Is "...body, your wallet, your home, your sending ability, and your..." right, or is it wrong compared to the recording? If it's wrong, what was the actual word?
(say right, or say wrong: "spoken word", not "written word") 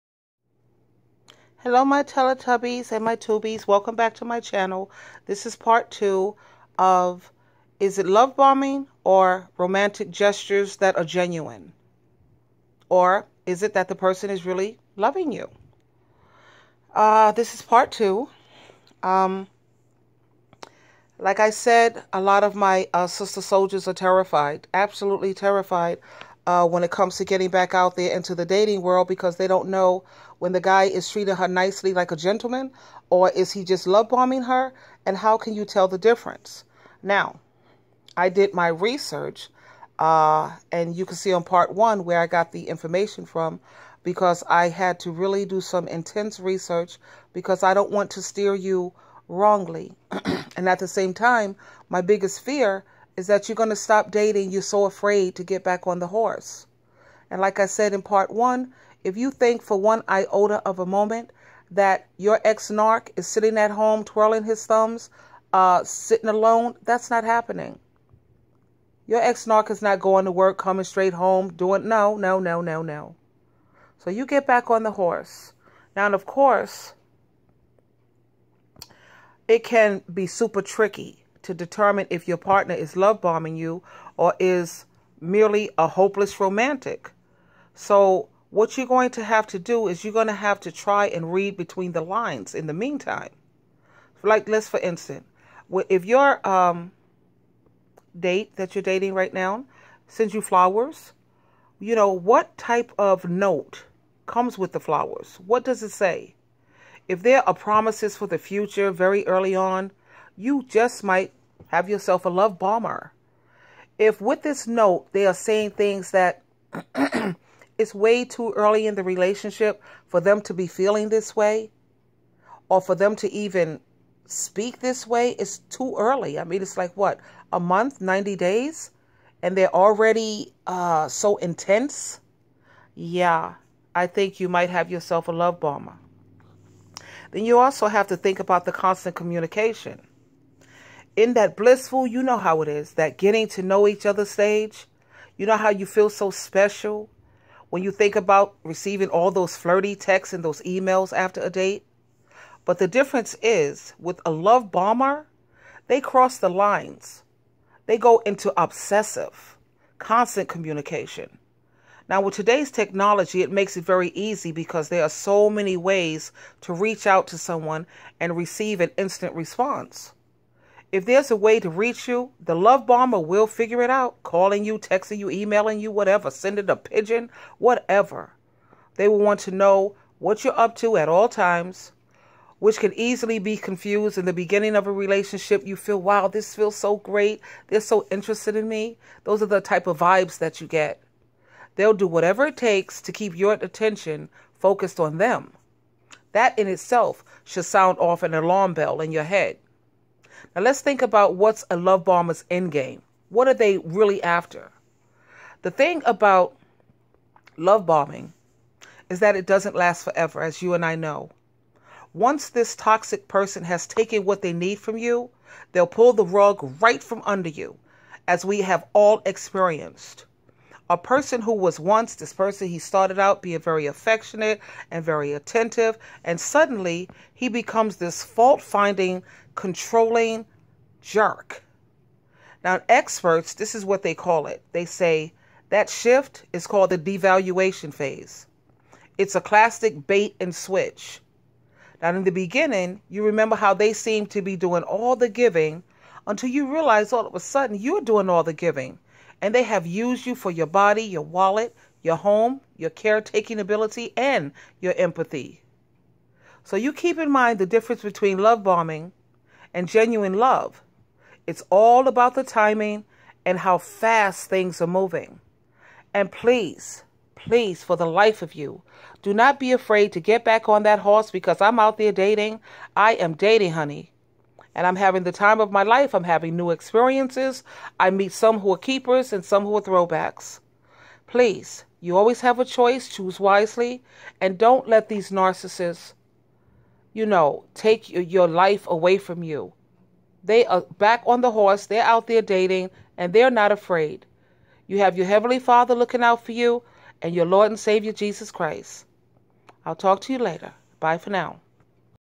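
wrong: "caretaking", not "sending".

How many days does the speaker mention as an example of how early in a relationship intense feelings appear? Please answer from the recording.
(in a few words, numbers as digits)
90.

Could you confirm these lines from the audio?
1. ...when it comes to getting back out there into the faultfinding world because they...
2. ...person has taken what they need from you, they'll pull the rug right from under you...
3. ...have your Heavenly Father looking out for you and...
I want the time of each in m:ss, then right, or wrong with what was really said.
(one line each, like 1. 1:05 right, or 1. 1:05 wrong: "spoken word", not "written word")
1. 0:26 wrong: "dating", not "faultfinding"
2. 3:33 right
3. 4:54 right.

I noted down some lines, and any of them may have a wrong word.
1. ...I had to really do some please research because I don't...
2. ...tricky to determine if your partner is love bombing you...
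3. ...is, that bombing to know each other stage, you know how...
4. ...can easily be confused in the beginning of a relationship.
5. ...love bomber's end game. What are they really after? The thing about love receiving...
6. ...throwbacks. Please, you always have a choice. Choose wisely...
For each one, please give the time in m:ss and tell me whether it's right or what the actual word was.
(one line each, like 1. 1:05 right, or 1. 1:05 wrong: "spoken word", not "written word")
1. 0:44 wrong: "intense", not "please"
2. 1:20 right
3. 2:22 wrong: "getting", not "bombing"
4. 3:02 right
5. 3:21 wrong: "bombing", not "receiving"
6. 4:39 right.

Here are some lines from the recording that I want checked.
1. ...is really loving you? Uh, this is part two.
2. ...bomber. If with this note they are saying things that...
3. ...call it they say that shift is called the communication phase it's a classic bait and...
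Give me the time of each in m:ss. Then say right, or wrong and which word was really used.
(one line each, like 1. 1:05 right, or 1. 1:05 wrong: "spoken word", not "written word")
1. 0:14 right
2. 1:52 right
3. 3:54 wrong: "devaluation", not "communication".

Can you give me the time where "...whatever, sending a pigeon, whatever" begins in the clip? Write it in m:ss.
2:55.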